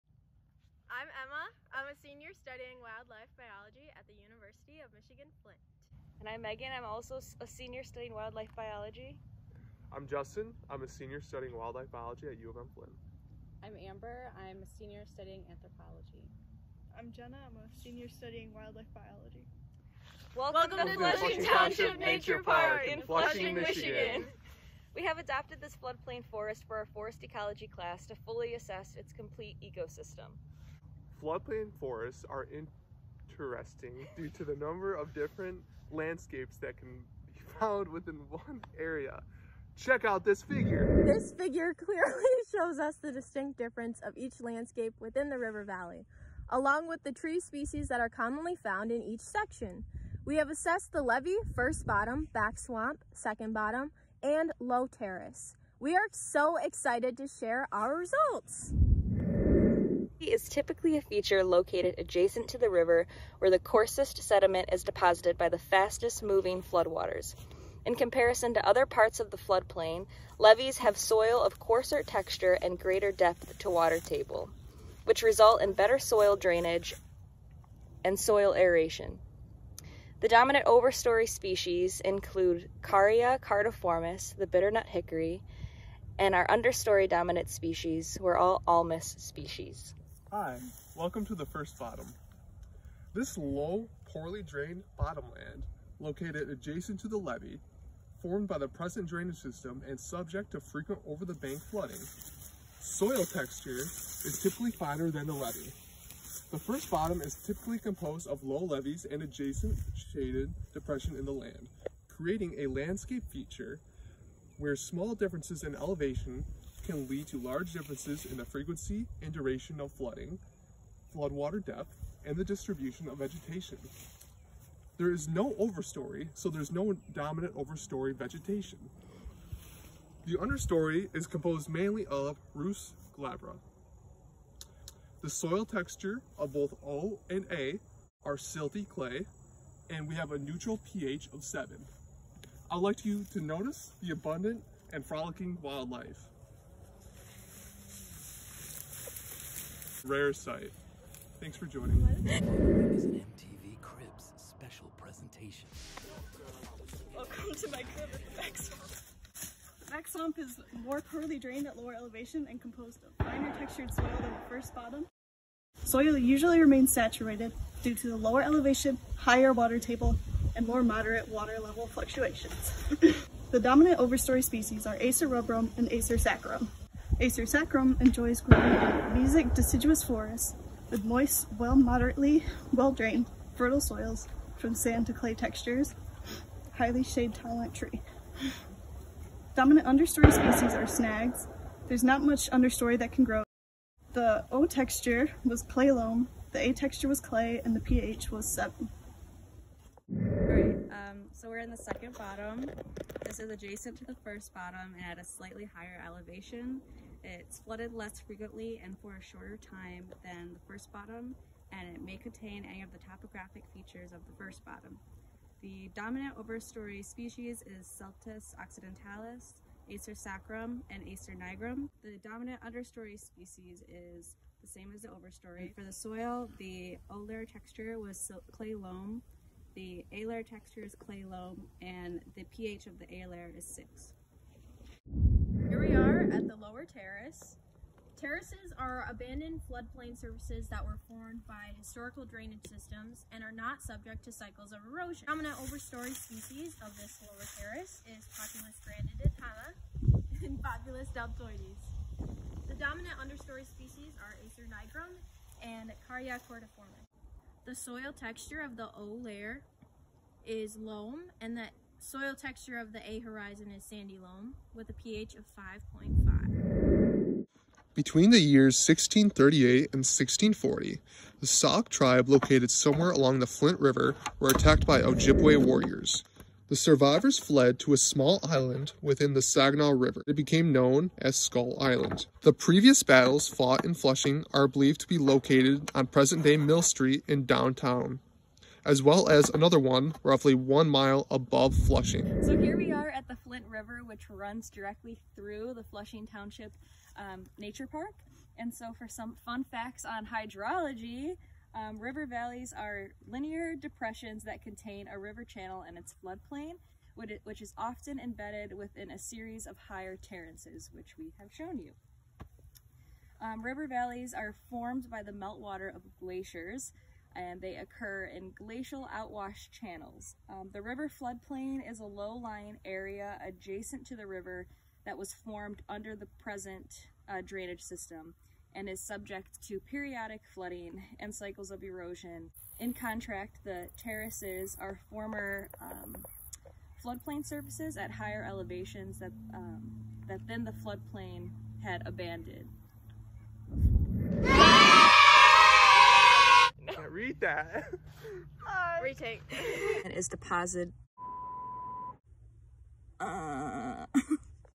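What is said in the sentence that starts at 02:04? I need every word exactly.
There is no overstory, so there's no dominant overstory vegetation.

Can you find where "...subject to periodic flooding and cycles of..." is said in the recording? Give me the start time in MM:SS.
05:29.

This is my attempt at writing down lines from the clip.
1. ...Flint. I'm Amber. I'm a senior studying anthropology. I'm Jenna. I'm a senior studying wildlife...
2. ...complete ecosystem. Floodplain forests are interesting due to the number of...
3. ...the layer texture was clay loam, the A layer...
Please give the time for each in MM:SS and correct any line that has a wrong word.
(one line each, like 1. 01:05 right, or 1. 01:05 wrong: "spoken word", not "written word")
1. 00:12 right
2. 00:29 right
3. 03:46 right.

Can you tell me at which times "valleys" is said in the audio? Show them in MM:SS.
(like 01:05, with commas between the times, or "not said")
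00:45, 05:02, 05:13.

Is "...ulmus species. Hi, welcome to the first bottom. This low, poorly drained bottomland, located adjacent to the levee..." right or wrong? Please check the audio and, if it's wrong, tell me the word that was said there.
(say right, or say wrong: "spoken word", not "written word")
right.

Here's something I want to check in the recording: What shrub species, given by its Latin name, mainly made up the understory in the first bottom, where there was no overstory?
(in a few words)
Rhus glabra.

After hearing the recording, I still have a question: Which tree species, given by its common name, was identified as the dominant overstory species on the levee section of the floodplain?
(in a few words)
bitternut hickory.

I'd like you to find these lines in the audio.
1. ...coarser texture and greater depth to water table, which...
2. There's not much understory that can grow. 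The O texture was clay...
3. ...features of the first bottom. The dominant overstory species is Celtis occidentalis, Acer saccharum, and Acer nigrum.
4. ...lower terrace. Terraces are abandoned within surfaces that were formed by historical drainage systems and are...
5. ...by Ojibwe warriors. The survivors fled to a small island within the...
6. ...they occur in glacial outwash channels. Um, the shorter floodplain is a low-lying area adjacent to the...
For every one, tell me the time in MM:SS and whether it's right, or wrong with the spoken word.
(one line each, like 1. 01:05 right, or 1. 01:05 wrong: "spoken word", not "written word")
1. 01:11 right
2. 03:11 right
3. 03:33 right
4. 03:56 wrong: "floodplain", not "within"
5. 04:34 right
6. 05:17 wrong: "river", not "shorter".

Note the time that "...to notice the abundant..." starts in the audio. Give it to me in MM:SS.
02:23.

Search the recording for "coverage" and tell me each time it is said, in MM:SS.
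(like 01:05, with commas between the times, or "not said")
not said.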